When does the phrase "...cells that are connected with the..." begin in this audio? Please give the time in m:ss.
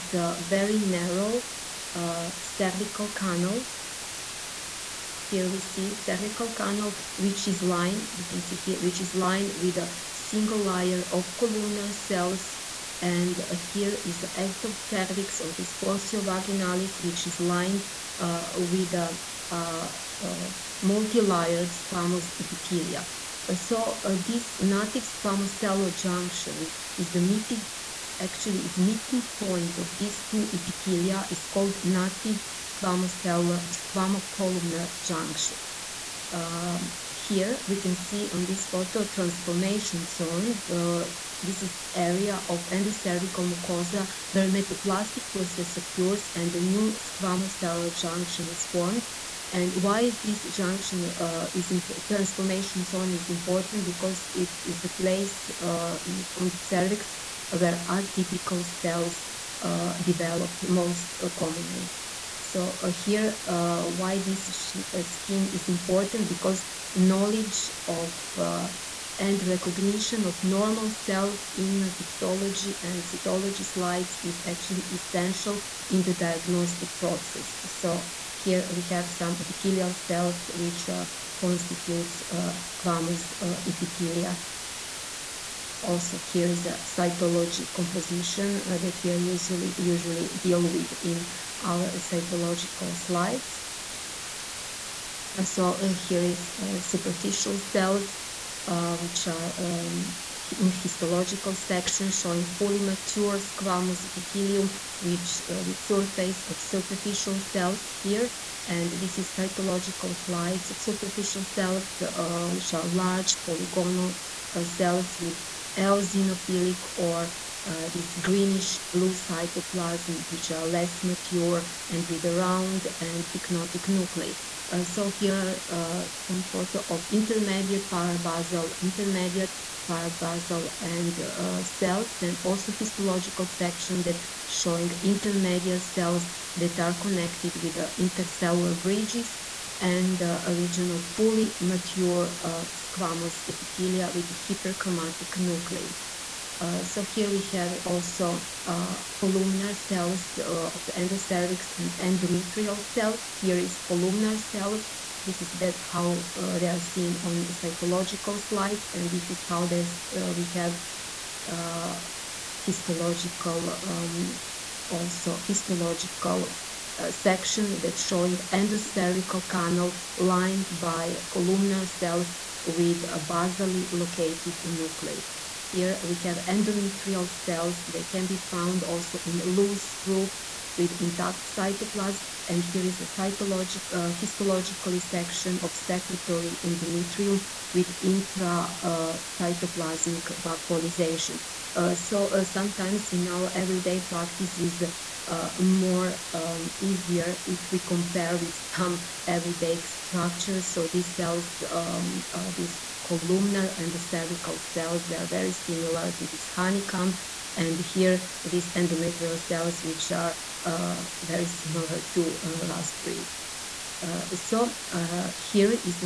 2:15.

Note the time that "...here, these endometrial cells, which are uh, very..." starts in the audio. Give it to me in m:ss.
3:27.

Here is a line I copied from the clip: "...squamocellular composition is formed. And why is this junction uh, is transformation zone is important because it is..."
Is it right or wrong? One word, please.
wrong.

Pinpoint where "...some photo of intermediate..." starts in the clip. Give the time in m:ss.
2:06.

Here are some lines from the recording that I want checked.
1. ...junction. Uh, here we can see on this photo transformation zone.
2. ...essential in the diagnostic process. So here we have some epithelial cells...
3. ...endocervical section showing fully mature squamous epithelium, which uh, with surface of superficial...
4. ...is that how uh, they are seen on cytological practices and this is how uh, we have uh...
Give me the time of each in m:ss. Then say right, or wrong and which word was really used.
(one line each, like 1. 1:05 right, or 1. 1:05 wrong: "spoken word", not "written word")
1. 0:34 right
2. 1:14 right
3. 1:40 wrong: "histological", not "endocervical"
4. 2:35 wrong: "slides", not "practices".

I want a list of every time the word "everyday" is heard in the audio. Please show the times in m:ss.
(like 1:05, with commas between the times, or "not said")
3:13, 3:19.